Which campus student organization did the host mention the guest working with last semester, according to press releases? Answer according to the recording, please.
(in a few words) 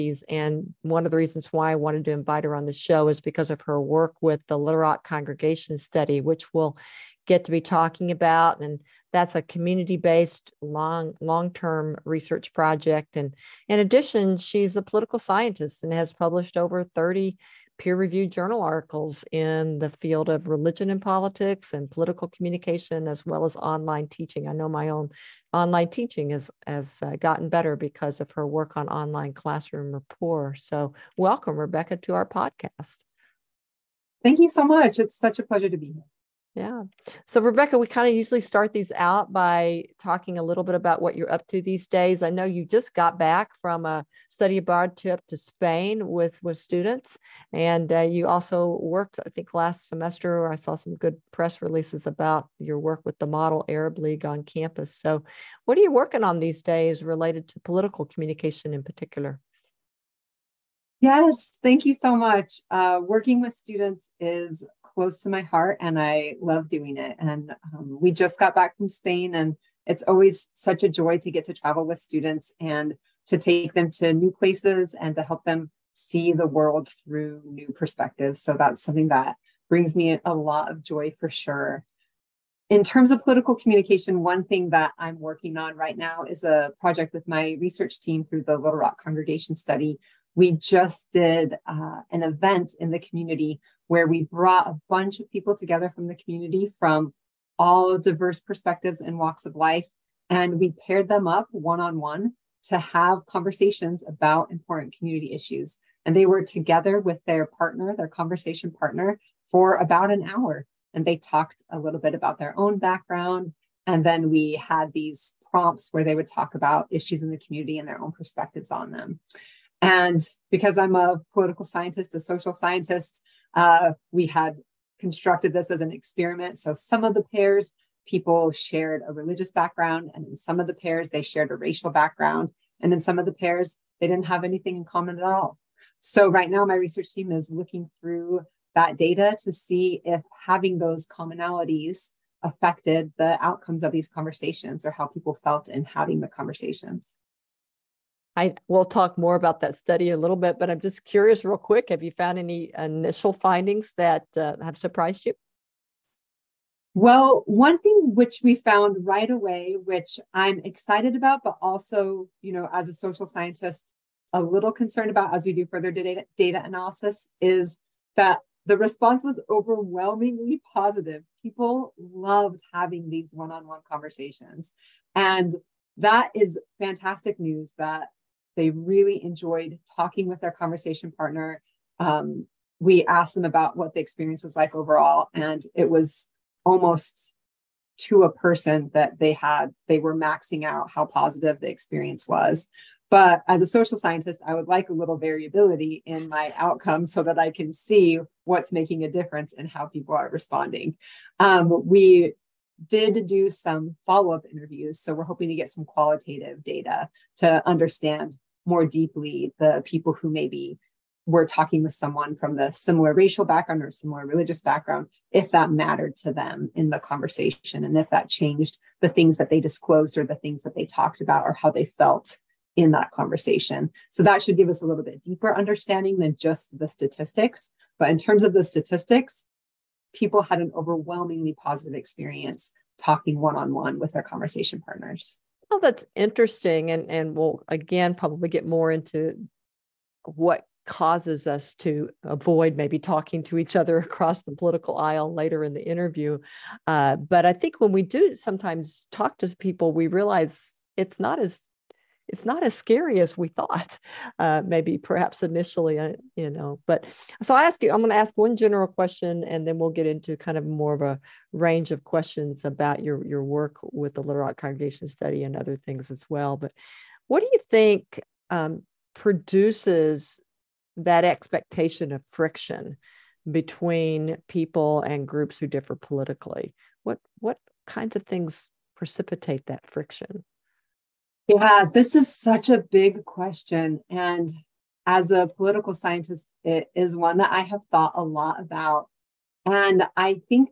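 Model Arab League.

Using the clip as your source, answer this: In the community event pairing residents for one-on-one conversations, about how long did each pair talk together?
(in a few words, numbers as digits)
about an hour.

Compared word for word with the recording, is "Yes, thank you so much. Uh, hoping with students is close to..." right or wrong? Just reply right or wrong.
wrong.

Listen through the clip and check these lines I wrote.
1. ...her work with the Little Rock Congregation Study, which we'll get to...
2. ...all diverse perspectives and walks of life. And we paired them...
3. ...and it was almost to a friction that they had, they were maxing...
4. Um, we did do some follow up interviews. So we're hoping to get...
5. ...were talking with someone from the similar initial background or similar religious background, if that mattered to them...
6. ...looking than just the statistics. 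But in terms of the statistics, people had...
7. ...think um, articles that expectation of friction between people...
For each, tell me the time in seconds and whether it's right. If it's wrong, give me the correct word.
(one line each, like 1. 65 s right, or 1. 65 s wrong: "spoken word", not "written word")
1. 3 s right
2. 97 s right
3. 185 s wrong: "person", not "friction"
4. 201 s right
5. 211 s wrong: "racial", not "initial"
6. 225 s wrong: "understanding", not "looking"
7. 267 s wrong: "produces", not "articles".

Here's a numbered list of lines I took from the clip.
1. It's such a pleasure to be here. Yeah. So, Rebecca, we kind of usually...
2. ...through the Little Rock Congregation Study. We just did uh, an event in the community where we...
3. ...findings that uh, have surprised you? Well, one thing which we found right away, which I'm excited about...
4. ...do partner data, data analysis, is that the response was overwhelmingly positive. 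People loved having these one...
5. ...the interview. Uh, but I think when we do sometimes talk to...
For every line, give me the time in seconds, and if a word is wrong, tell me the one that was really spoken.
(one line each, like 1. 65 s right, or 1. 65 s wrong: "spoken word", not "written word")
1. 34 s right
2. 88 s right
3. 153 s right
4. 165 s wrong: "further", not "partner"
5. 245 s right.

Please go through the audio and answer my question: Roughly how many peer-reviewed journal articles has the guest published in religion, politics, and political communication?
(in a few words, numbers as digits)
over 30.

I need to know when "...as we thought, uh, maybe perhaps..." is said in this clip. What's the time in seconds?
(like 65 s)
253 s.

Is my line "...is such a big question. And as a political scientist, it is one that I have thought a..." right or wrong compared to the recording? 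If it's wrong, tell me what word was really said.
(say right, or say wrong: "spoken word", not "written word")
right.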